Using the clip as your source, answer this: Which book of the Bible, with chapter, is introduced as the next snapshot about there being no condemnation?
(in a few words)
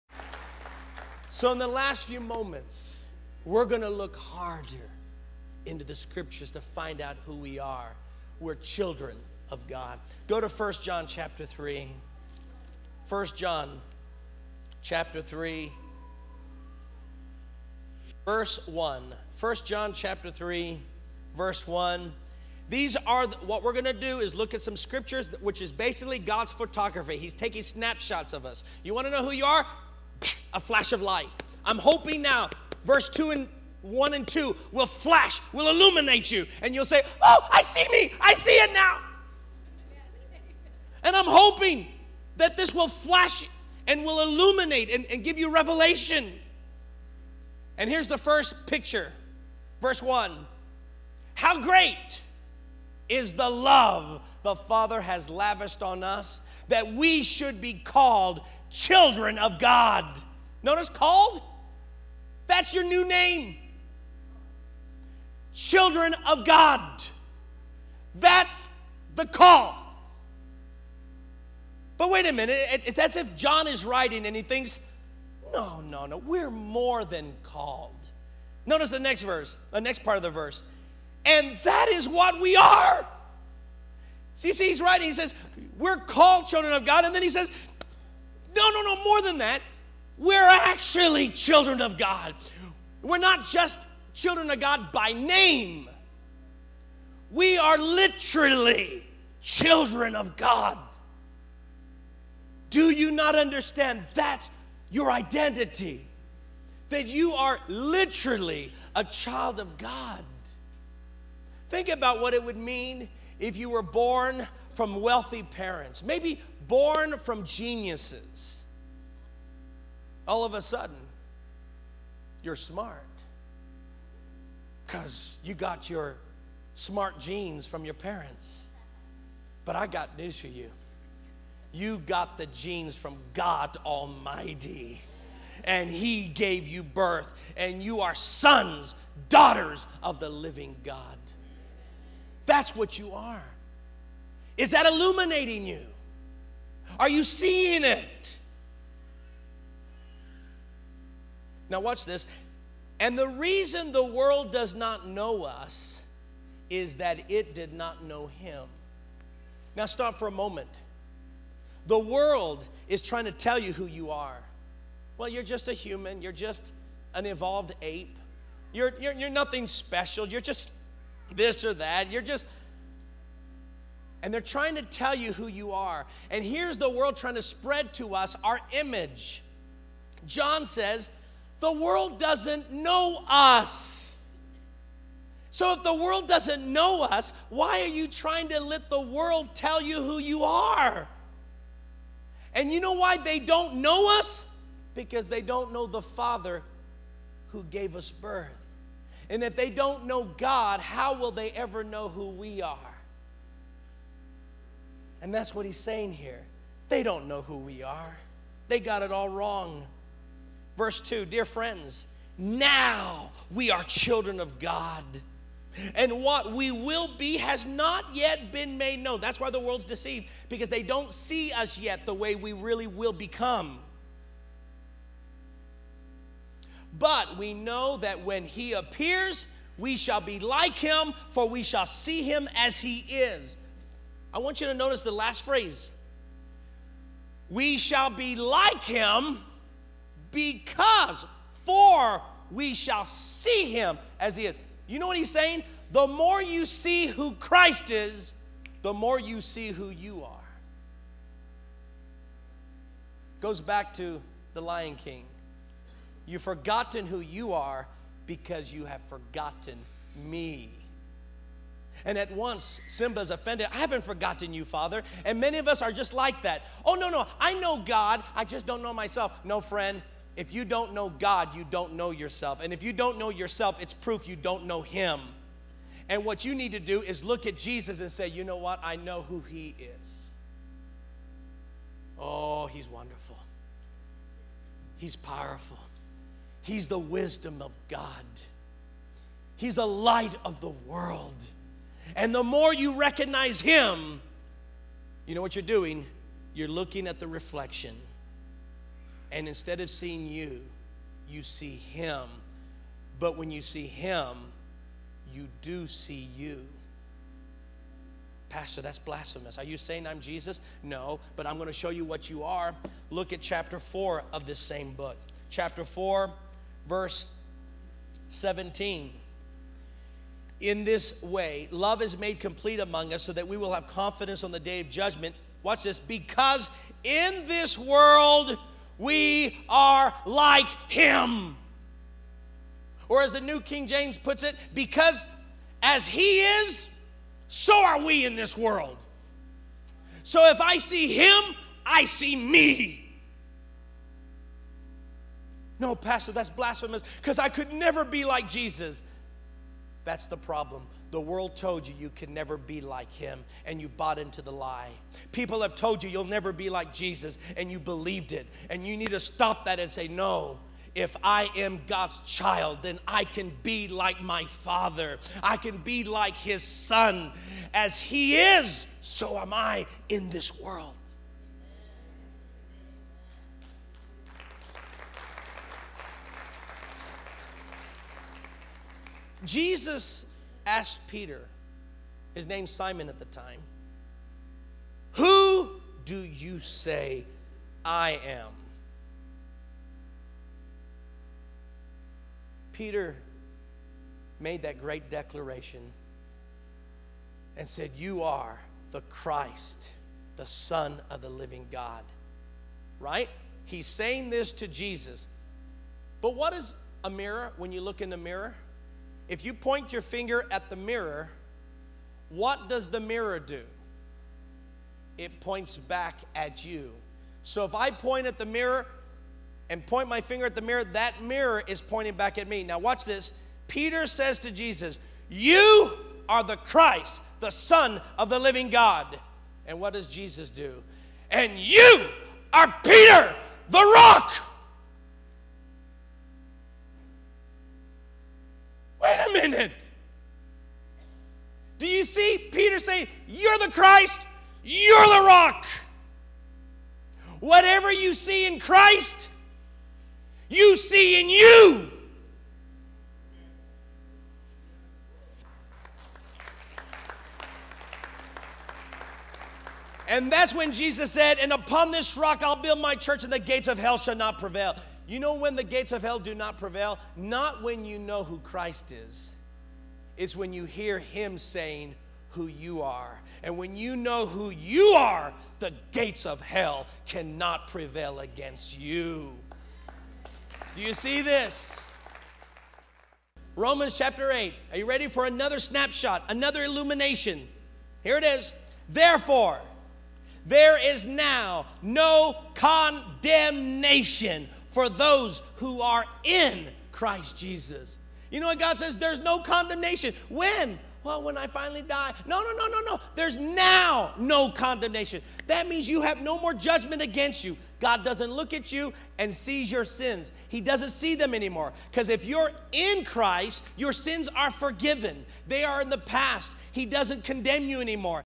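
Romans chapter 8.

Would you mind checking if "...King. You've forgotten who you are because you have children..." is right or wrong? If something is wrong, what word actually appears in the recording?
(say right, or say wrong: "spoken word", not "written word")
wrong: "forgotten", not "children".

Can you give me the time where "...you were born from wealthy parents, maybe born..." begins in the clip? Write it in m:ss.
1:53.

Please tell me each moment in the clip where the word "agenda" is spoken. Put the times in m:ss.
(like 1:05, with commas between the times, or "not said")
not said.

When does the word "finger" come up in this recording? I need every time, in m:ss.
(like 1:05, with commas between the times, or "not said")
6:50, 7:00.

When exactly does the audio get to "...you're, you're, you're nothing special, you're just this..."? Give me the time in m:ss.
2:48.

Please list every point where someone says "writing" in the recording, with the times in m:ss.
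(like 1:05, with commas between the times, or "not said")
1:13, 1:24.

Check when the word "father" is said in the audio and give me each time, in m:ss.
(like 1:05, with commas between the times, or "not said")
0:54, 3:16, 4:24, 6:04.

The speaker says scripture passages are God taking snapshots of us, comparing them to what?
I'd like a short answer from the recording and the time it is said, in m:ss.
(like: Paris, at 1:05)
God's photography, at 0:26.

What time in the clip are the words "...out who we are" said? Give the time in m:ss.
0:06.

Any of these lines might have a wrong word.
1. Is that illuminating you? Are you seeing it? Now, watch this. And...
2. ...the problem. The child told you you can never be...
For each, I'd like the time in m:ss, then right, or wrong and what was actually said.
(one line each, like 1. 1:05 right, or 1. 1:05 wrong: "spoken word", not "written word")
1. 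2:24 right
2. 5:50 wrong: "world", not "child".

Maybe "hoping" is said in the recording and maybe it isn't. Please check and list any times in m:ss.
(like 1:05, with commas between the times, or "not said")
0:31, 0:41.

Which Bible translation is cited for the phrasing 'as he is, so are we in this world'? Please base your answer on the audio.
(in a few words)
New King James.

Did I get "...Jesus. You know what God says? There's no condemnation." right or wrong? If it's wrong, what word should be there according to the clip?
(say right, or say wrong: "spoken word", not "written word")
right.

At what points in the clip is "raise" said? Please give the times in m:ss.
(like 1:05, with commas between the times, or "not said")
not said.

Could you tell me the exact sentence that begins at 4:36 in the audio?
And what you need to do is look at Jesus and say, you know what?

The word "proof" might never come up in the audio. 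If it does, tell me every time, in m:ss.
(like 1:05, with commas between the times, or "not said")
4:33.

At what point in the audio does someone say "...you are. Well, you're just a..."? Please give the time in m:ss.
2:43.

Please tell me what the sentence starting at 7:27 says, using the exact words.
Whatever you see in Christ, you see in you.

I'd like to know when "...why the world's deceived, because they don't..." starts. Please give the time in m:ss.
3:39.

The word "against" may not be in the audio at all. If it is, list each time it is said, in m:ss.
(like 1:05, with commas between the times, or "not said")
7:58, 8:27.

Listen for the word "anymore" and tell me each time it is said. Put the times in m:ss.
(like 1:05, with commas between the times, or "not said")
8:31, 8:37.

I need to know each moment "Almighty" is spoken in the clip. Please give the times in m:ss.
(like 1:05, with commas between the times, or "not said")
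2:13.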